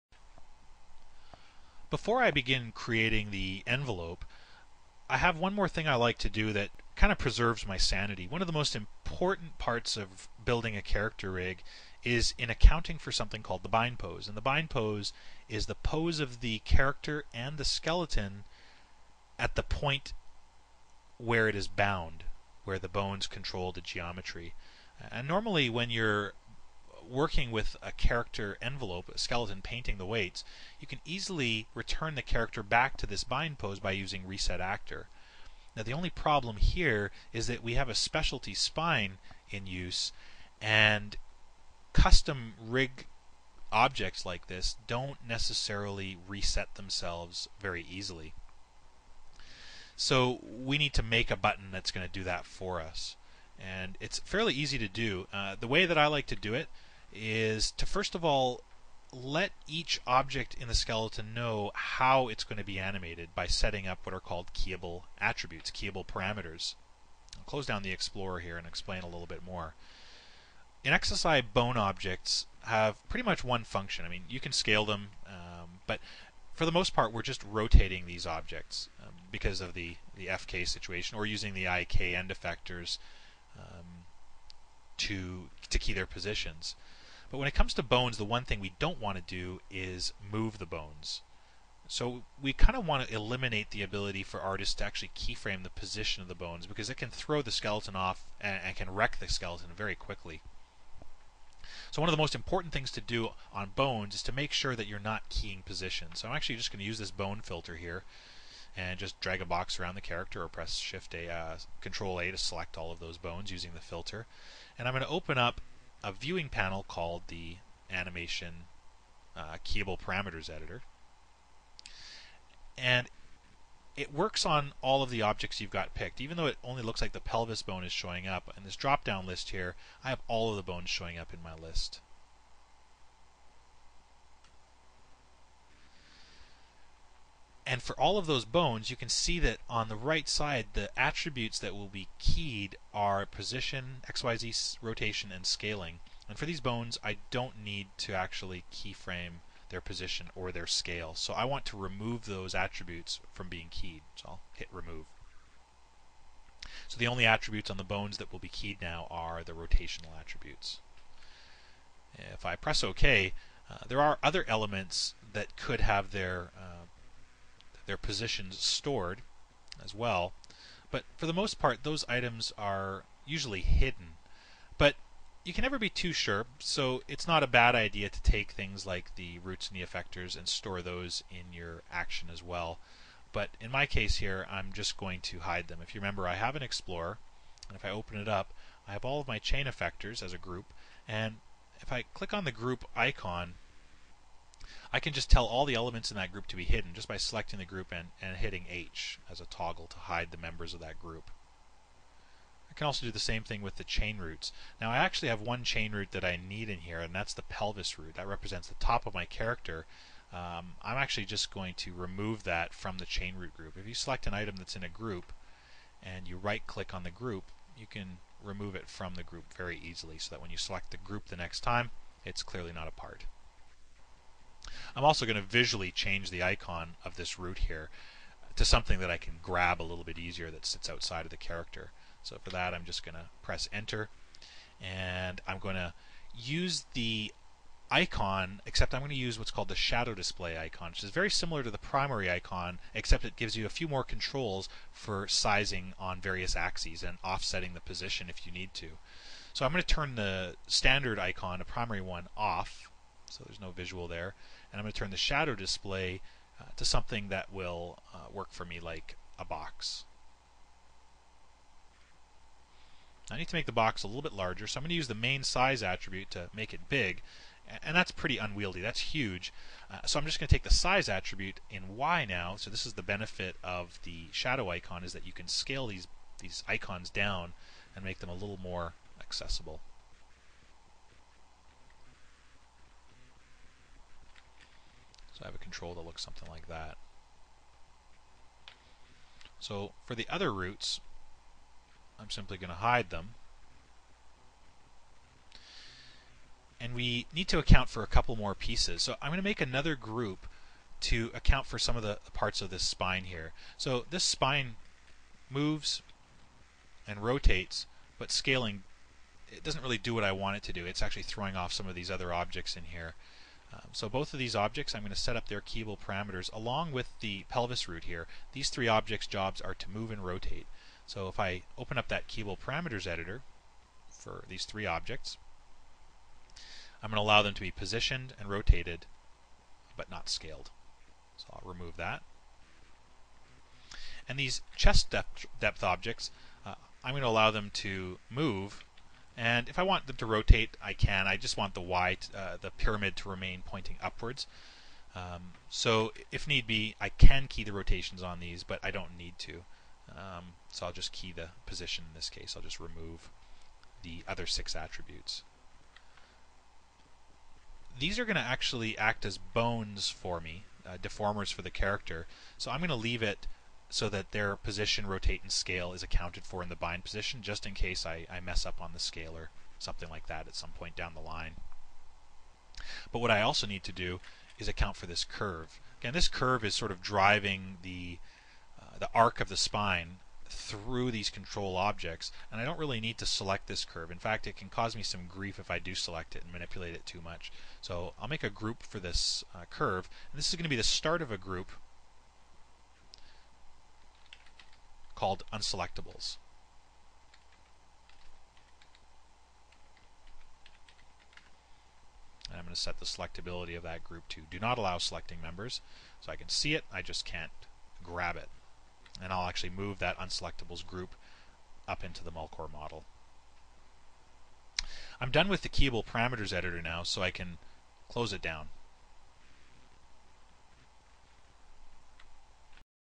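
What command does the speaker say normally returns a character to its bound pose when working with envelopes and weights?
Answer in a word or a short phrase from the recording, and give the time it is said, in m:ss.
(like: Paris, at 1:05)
reset actor, at 0:34.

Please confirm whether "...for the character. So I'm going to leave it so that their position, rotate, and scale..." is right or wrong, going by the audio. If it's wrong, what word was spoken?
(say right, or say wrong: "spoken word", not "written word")
right.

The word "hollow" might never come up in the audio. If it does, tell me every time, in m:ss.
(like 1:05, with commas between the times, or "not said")
not said.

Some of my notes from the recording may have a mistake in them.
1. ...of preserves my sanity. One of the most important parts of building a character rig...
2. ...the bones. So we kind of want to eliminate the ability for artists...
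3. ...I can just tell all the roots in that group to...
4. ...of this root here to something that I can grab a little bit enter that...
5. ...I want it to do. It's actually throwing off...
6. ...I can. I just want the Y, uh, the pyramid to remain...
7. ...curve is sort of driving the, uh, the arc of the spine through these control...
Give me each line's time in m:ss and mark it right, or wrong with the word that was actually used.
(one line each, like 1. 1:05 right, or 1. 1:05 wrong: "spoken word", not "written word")
1. 0:07 right
2. 1:30 right
3. 3:14 wrong: "elements", not "roots"
4. 3:47 wrong: "easier", not "enter"
5. 5:10 right
6. 5:40 right
7. 6:16 right.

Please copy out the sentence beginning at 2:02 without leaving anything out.
And it works on all of the objects you've got picked.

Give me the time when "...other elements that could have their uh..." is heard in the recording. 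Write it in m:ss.
2:44.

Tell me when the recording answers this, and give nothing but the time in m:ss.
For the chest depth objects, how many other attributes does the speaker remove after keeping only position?
5:54.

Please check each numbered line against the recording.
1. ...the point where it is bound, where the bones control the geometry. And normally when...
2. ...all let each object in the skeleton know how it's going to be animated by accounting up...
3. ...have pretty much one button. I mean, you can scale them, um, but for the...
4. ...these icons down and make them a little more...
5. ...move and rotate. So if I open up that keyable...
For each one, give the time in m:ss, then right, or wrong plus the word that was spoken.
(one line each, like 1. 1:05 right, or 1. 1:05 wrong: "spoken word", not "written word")
1. 0:19 right
2. 0:58 wrong: "setting", not "accounting"
3. 1:12 wrong: "function", not "button"
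4. 4:36 right
5. 5:19 right.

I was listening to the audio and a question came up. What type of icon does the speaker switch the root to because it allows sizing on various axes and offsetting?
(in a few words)
shadow display icon.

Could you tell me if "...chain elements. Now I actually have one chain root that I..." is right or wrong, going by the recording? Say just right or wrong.
wrong.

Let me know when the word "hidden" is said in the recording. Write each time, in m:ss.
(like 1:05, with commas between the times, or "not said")
2:53, 3:16.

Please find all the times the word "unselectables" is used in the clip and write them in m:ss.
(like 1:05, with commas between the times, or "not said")
6:35, 6:50.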